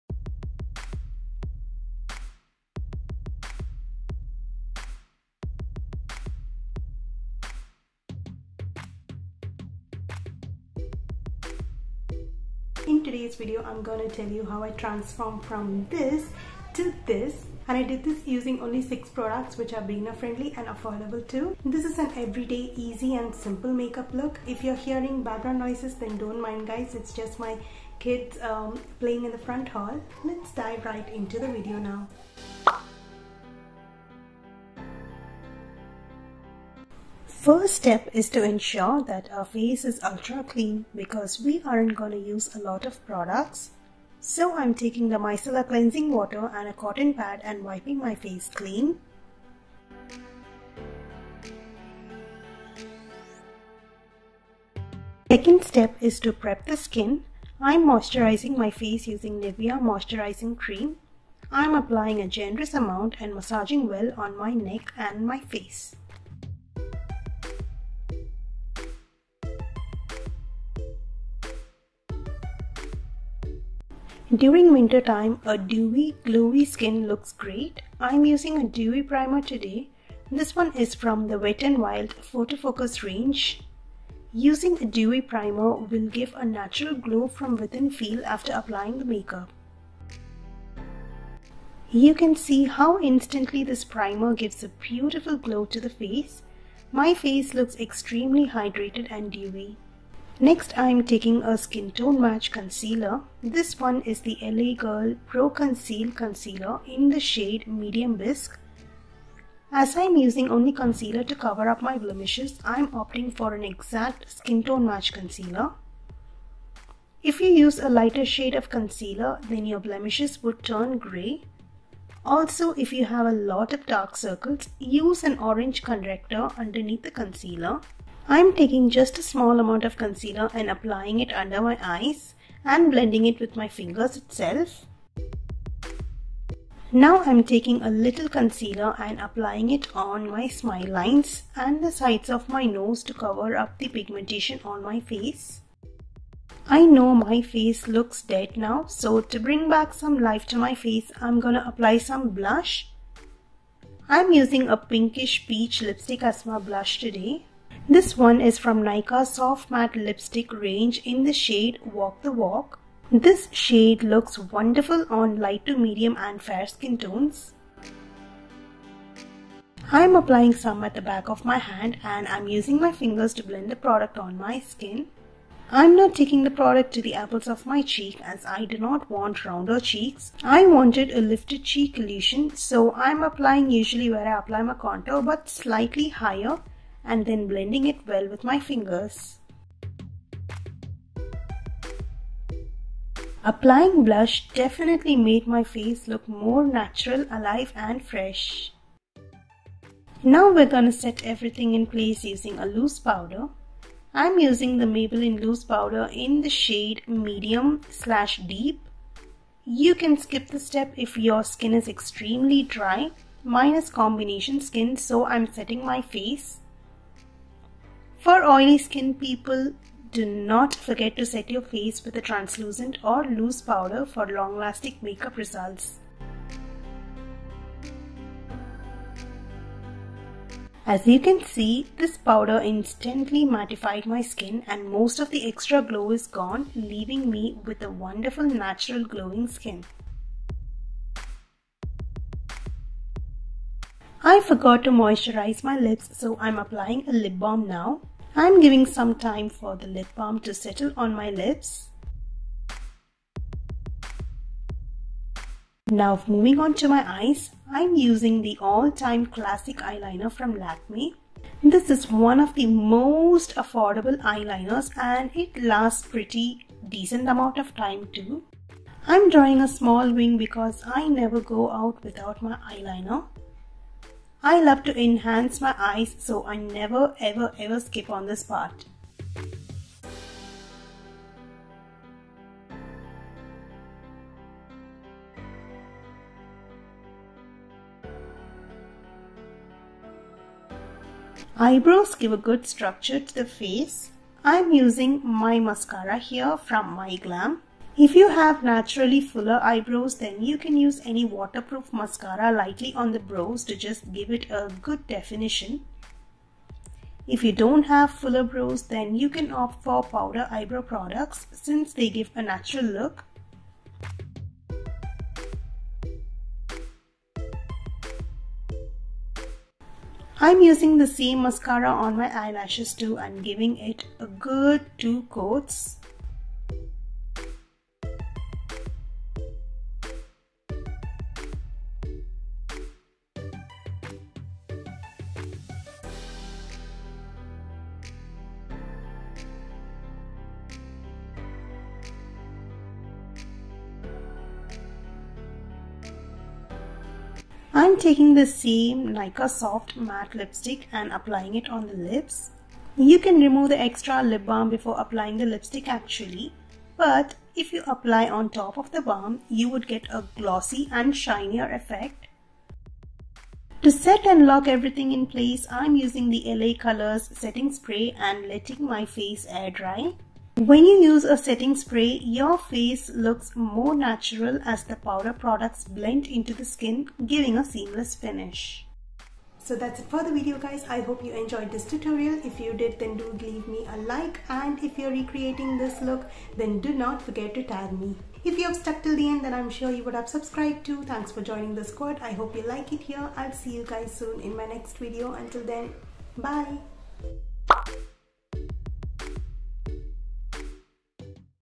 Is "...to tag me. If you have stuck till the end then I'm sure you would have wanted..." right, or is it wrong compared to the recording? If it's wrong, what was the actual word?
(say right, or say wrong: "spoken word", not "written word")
wrong: "subscribed", not "wanted".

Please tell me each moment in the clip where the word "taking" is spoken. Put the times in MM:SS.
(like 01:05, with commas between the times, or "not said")
00:44, 01:41, 02:08, 02:17, 02:56, 05:48.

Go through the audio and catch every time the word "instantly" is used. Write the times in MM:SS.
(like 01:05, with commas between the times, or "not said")
01:33, 03:52.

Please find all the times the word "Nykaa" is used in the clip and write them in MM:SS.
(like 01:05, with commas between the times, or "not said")
02:38, 05:49.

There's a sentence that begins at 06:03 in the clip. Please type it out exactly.
To set and lock everything in place, I'm using the LA Colors setting spray and letting my face air dry.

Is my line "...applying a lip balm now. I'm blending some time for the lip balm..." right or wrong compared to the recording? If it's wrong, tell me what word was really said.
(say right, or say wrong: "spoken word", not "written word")
wrong: "giving", not "blending".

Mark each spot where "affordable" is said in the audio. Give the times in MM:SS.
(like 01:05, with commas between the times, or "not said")
00:20, 04:23.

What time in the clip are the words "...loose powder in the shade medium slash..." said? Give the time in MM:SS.
03:25.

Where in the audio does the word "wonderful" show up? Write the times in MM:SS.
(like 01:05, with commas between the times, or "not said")
02:44, 03:57.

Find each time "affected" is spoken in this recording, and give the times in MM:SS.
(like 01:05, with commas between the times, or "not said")
not said.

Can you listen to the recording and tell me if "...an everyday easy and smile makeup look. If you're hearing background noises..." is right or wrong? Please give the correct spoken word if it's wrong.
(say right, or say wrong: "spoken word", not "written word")
wrong: "simple", not "smile".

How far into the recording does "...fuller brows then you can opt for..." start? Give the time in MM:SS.
05:08.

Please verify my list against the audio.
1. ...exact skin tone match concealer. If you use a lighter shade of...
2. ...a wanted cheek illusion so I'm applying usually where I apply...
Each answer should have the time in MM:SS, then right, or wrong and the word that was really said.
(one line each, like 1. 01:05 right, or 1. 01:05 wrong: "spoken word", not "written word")
1. 01:53 right
2. 03:01 wrong: "lifted", not "wanted".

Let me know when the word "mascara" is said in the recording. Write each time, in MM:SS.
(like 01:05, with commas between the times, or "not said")
04:55, 05:01, 05:21.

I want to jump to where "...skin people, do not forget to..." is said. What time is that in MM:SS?
03:38.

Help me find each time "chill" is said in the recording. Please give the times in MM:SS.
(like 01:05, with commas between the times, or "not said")
not said.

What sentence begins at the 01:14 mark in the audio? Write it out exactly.
During winter time, a dewy, glowy skin looks great.